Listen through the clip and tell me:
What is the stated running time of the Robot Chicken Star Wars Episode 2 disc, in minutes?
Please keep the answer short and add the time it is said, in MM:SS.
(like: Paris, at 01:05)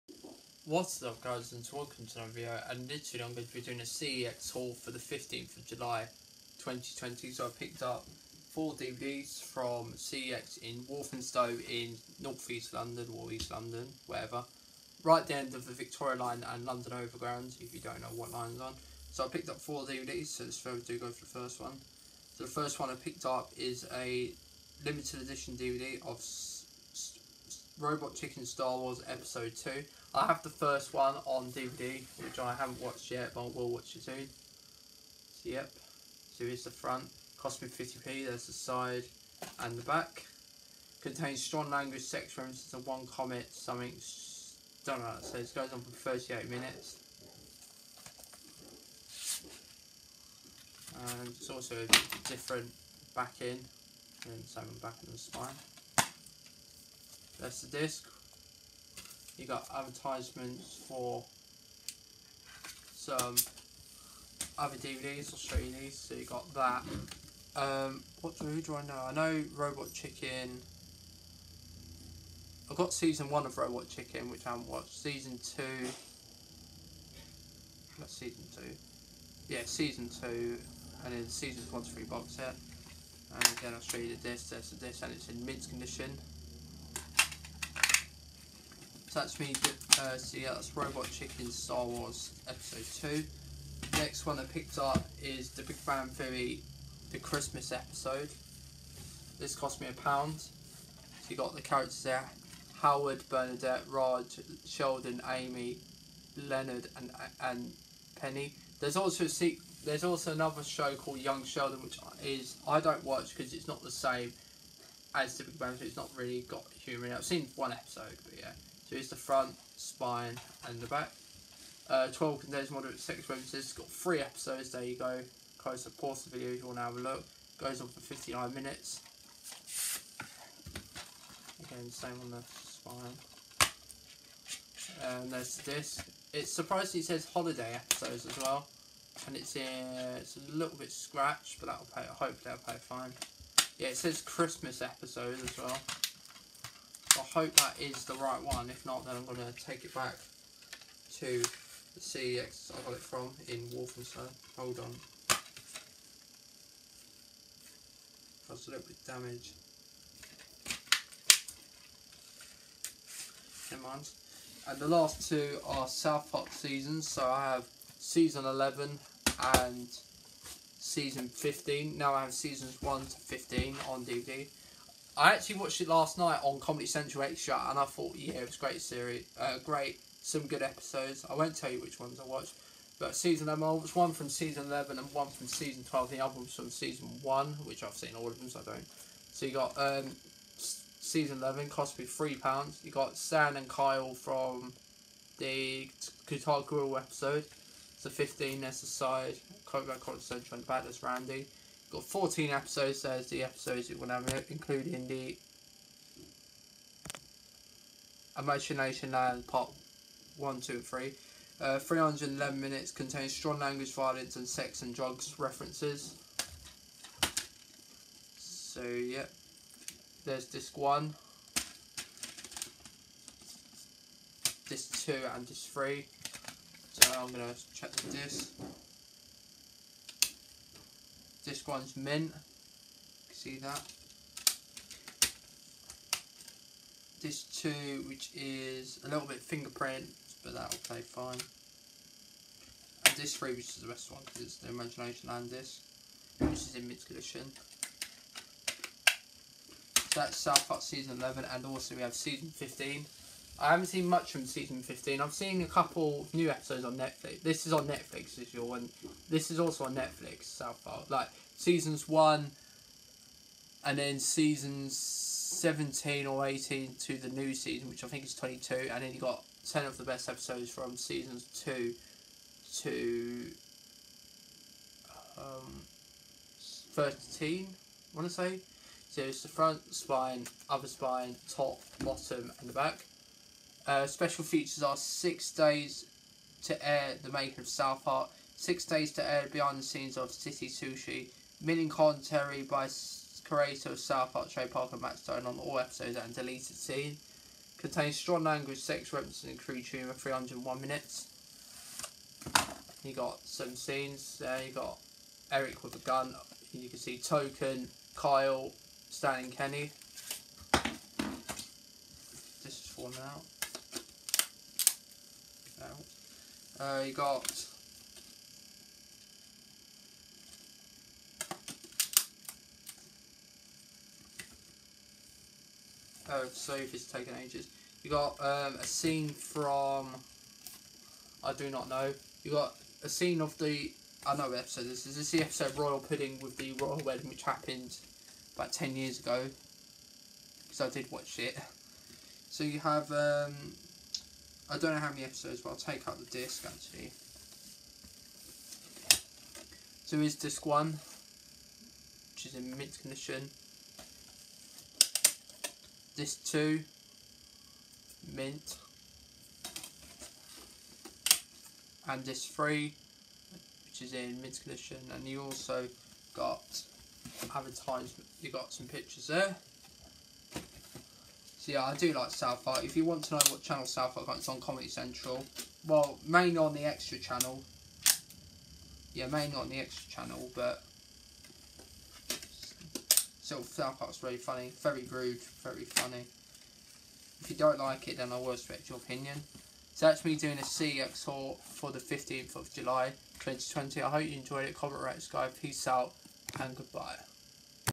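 38 minutes, at 00:46.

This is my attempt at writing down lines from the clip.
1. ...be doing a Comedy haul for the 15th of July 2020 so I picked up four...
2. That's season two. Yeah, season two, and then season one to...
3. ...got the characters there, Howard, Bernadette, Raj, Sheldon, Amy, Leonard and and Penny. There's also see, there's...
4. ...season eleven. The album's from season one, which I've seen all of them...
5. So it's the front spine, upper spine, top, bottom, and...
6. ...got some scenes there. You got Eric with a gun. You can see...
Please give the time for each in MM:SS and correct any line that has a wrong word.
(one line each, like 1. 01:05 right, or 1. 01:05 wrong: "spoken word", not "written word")
1. 00:03 wrong: "CEX", not "Comedy"
2. 01:17 right
3. 01:41 right
4. 03:05 wrong: "twelve", not "eleven"
5. 04:39 right
6. 05:03 right.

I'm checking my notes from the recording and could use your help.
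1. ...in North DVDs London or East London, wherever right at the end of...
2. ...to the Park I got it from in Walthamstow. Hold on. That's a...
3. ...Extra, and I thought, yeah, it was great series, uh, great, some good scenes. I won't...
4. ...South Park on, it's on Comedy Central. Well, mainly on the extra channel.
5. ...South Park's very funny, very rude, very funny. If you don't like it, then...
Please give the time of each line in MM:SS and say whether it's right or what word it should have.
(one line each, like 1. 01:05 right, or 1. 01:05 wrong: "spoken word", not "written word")
1. 00:11 wrong: "East", not "DVDs"
2. 02:31 wrong: "CEX", not "Park"
3. 02:57 wrong: "episodes", not "scenes"
4. 06:13 right
5. 06:23 right.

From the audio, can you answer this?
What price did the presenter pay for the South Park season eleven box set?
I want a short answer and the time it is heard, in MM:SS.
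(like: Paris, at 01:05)
3 pounds, at 03:12.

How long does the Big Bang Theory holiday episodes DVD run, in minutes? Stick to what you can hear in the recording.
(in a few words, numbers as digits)
59 minutes.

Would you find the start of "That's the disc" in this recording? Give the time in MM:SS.
00:57.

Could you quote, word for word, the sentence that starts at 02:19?
And it's, uh, it's a little bit scratched, but that'll pay, hopefully that'll pay fine.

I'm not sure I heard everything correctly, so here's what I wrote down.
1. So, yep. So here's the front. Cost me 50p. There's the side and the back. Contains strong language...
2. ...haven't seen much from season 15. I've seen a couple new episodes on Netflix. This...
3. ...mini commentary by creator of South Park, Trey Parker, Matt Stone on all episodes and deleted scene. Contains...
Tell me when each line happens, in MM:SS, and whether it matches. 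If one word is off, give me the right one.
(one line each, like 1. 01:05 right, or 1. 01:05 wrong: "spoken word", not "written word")
1. 00:35 right
2. 04:13 right
3. 04:51 right.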